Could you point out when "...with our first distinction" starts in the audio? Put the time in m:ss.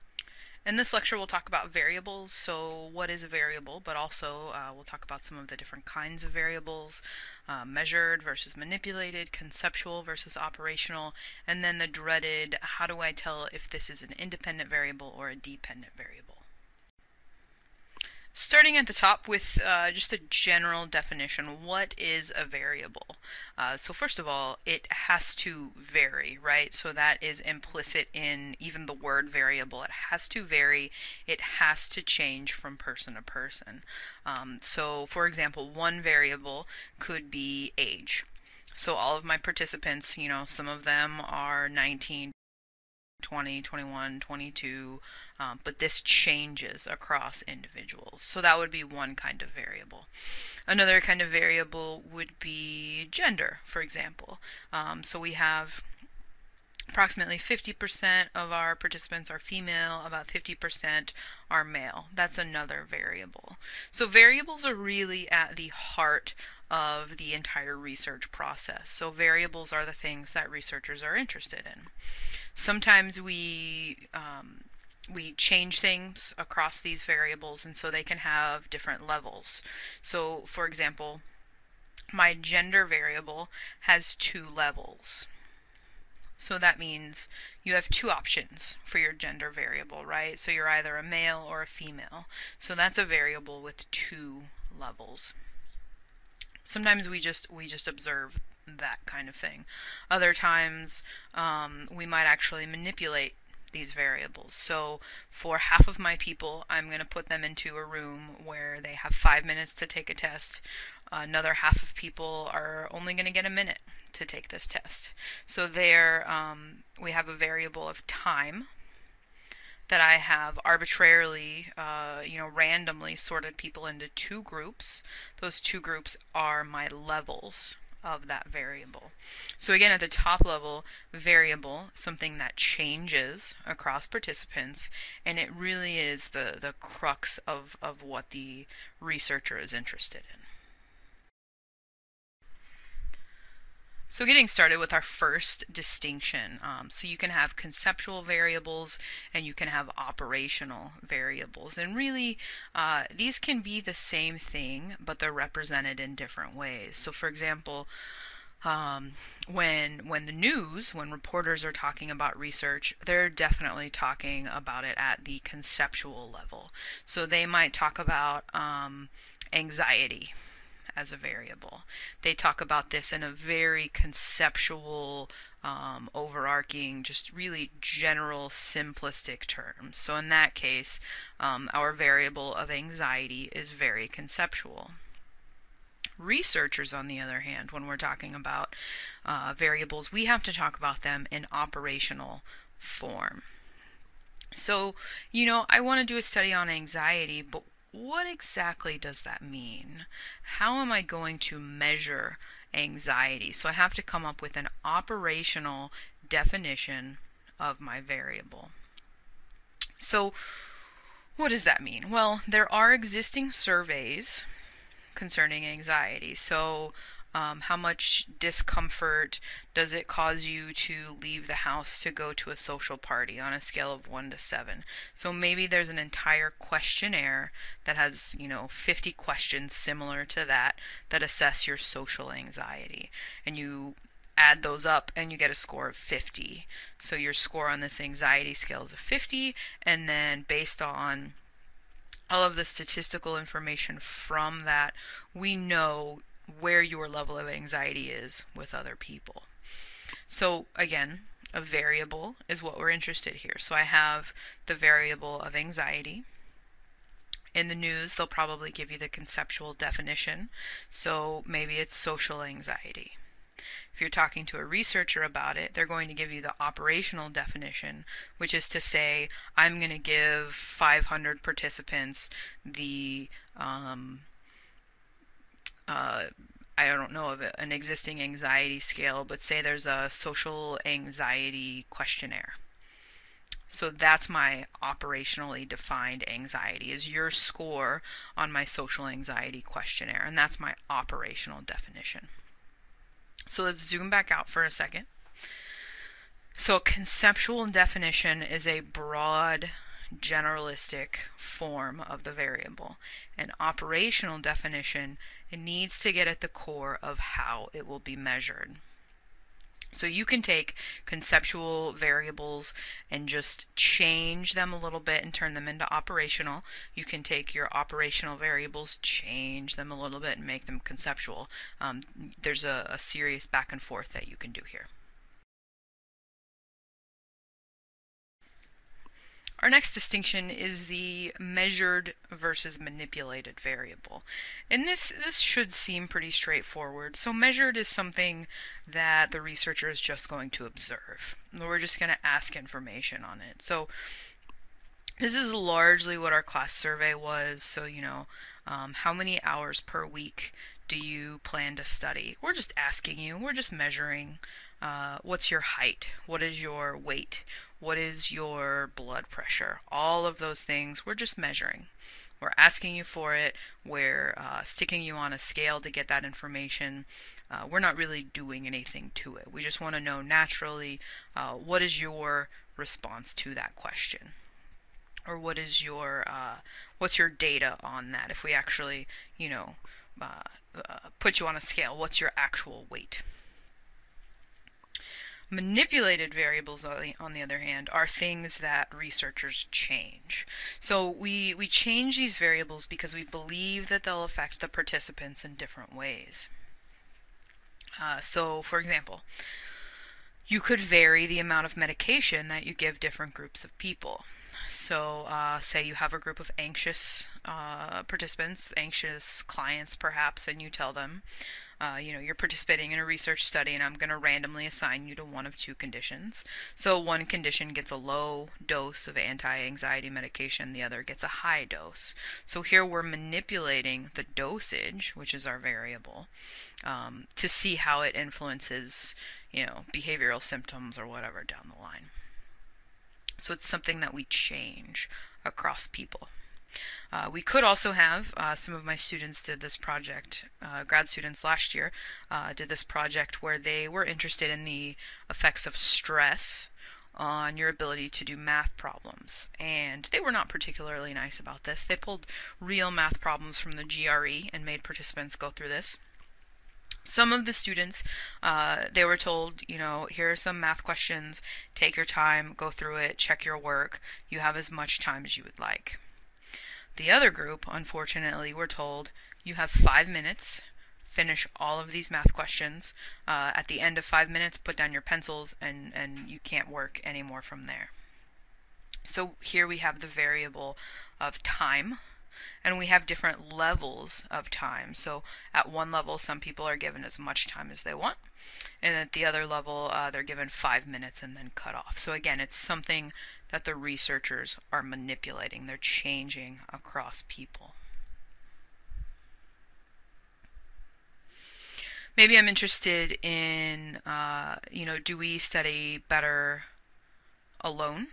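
2:24.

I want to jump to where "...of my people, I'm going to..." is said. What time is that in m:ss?
1:45.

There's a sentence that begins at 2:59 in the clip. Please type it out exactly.
So in that case, um, our variable of anxiety is very conceptual.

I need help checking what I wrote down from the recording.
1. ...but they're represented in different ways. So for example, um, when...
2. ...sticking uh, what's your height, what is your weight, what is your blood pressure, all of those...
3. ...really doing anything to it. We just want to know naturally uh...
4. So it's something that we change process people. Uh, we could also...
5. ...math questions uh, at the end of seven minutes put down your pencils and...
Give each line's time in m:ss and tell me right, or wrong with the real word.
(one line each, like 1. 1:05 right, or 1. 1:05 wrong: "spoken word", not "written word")
1. 2:34 right
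2. 5:53 wrong: "measuring", not "sticking"
3. 6:07 right
4. 7:13 wrong: "across", not "process"
5. 7:52 wrong: "five", not "seven".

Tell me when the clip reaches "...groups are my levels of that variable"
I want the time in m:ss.
2:05.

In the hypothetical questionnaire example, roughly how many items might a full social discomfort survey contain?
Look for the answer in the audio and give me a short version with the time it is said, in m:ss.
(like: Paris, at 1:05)
50 questions, at 3:48.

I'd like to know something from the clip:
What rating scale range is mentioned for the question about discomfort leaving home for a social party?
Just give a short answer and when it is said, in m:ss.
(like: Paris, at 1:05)
1 to 7, at 3:44.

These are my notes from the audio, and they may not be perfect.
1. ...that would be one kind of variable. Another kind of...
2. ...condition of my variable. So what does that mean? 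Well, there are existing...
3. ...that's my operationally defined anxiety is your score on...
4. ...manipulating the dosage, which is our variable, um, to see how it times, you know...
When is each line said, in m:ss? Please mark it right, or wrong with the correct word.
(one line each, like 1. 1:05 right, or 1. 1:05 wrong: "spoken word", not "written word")
1. 0:48 right
2. 3:26 wrong: "definition", not "condition"
3. 4:43 right
4. 7:03 wrong: "influences", not "times".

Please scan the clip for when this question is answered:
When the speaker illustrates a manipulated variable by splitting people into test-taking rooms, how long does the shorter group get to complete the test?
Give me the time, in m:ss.
1:53.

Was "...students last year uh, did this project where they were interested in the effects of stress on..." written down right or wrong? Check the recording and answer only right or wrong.
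right.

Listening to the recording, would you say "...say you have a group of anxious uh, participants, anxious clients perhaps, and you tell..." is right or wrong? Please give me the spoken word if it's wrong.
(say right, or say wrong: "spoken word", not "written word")
right.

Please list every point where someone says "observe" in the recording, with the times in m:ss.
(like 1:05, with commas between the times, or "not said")
1:37, 5:40.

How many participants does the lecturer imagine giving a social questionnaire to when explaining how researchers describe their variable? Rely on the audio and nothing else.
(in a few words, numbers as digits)
500.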